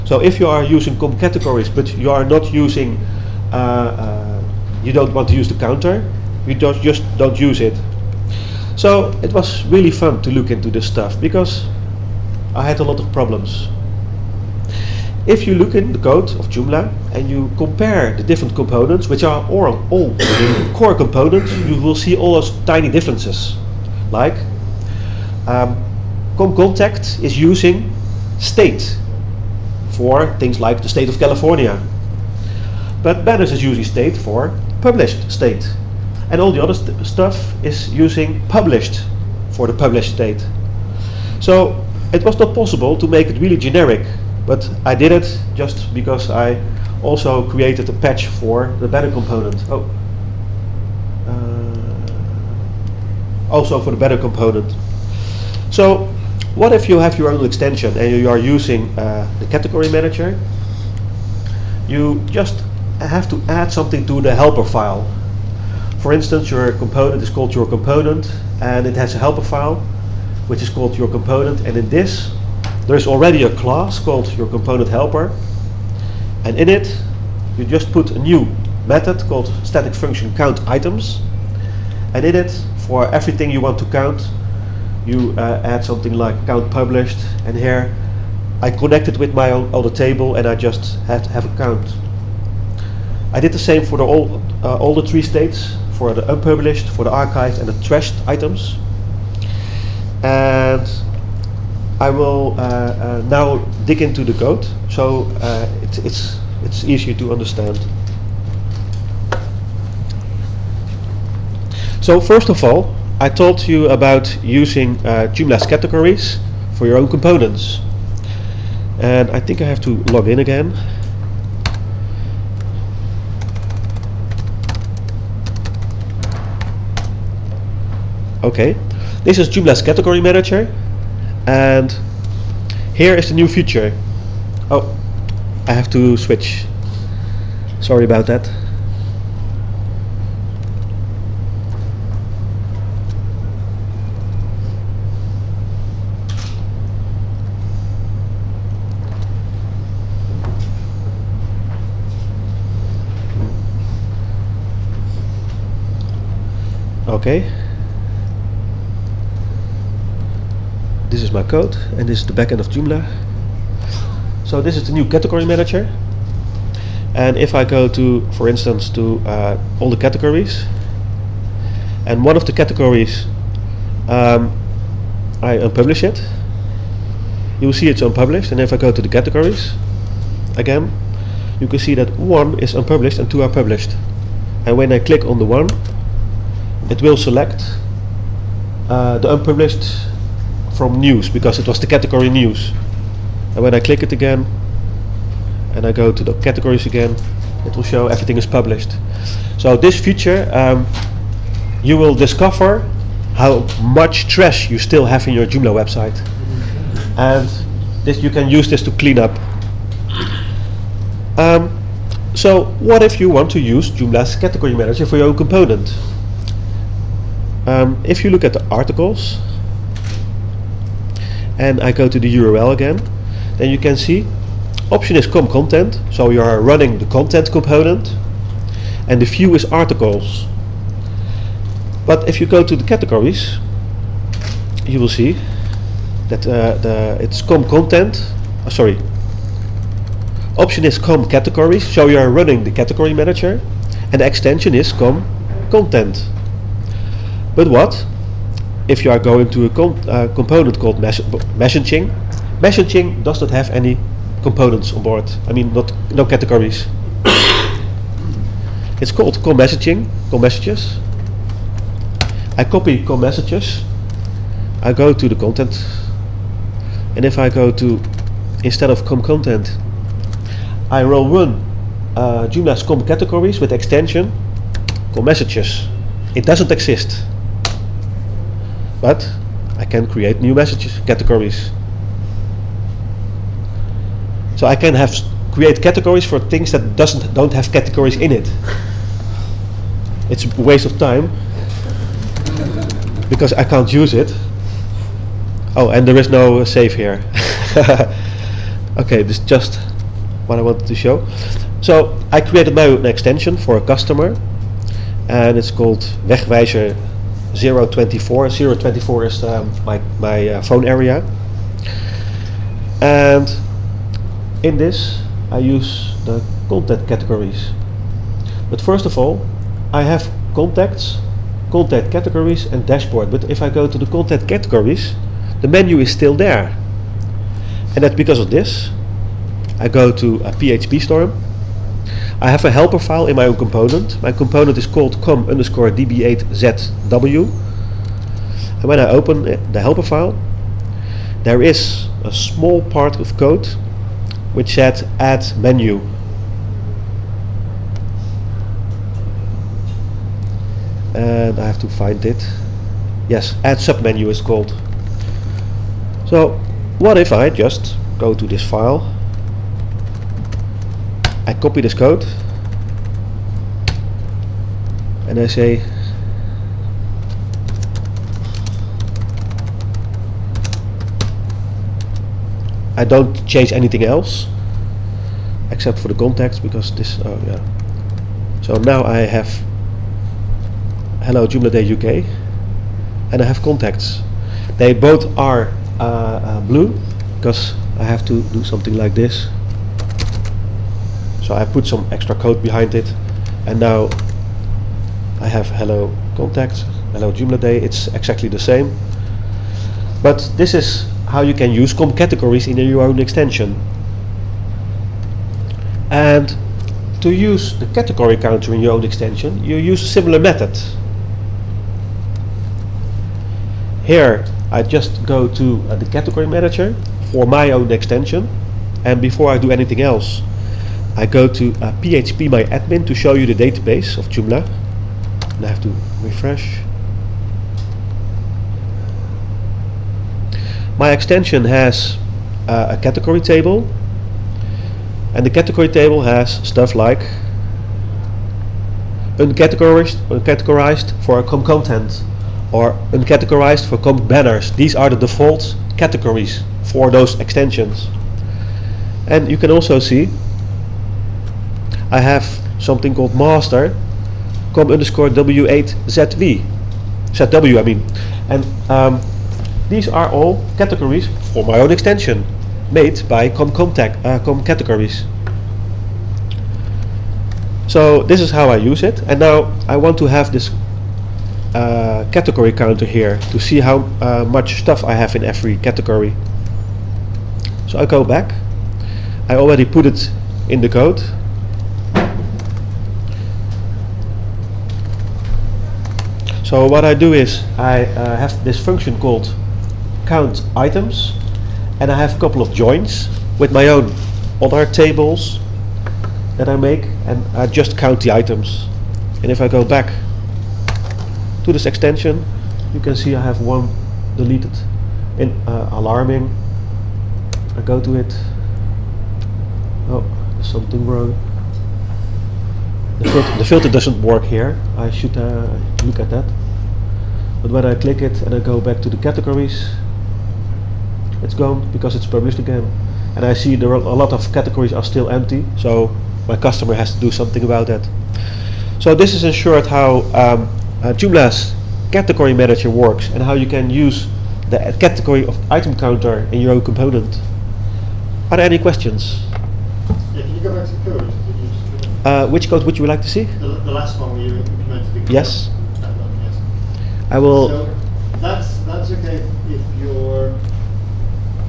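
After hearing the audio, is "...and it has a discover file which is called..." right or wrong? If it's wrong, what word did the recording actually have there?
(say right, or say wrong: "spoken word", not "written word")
wrong: "helper", not "discover".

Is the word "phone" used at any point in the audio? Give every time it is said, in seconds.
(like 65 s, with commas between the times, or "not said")
310 s.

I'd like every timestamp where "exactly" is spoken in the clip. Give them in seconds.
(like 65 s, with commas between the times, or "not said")
398 s.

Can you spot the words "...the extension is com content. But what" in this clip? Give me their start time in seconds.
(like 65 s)
244 s.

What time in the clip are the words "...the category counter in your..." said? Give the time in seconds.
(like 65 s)
407 s.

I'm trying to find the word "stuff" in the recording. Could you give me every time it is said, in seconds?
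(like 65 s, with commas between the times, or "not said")
10 s, 37 s, 436 s, 474 s.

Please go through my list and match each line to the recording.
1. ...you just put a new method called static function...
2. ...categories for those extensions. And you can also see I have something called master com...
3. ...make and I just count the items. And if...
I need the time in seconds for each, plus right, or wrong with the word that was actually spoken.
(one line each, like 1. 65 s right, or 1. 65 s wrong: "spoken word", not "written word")
1. 77 s right
2. 445 s right
3. 496 s right.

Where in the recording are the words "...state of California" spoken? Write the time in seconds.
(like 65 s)
30 s.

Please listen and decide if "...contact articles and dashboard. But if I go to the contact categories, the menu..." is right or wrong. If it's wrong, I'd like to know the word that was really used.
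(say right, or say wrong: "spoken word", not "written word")
wrong: "categories", not "articles".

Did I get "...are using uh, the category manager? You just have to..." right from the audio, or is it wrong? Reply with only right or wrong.
right.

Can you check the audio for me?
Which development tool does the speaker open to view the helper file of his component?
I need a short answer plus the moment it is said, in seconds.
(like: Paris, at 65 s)
PHP storm, at 330 s.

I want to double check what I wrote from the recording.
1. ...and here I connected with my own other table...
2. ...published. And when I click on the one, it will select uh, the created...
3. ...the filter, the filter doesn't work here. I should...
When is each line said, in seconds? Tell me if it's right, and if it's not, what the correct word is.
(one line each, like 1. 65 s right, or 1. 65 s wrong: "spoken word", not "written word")
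1. 87 s right
2. 183 s wrong: "unpublished", not "created"
3. 513 s right.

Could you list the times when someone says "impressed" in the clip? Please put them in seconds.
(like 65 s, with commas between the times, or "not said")
not said.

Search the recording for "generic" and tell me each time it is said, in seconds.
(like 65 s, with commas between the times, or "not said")
43 s.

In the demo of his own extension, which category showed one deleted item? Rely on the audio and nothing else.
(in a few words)
alarming.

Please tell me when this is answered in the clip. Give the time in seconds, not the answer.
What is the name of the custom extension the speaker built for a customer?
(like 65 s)
306 s.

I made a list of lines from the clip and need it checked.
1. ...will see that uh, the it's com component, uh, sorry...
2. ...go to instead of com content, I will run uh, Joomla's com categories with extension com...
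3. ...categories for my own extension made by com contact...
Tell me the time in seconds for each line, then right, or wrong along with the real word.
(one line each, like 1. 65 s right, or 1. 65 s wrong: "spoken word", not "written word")
1. 235 s wrong: "content", not "component"
2. 267 s right
3. 460 s right.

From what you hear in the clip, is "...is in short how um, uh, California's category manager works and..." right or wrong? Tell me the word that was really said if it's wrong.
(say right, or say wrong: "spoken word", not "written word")
wrong: "Joomla", not "California".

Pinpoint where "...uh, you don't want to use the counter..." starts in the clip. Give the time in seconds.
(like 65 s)
3 s.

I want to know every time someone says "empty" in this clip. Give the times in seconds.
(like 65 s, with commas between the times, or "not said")
525 s.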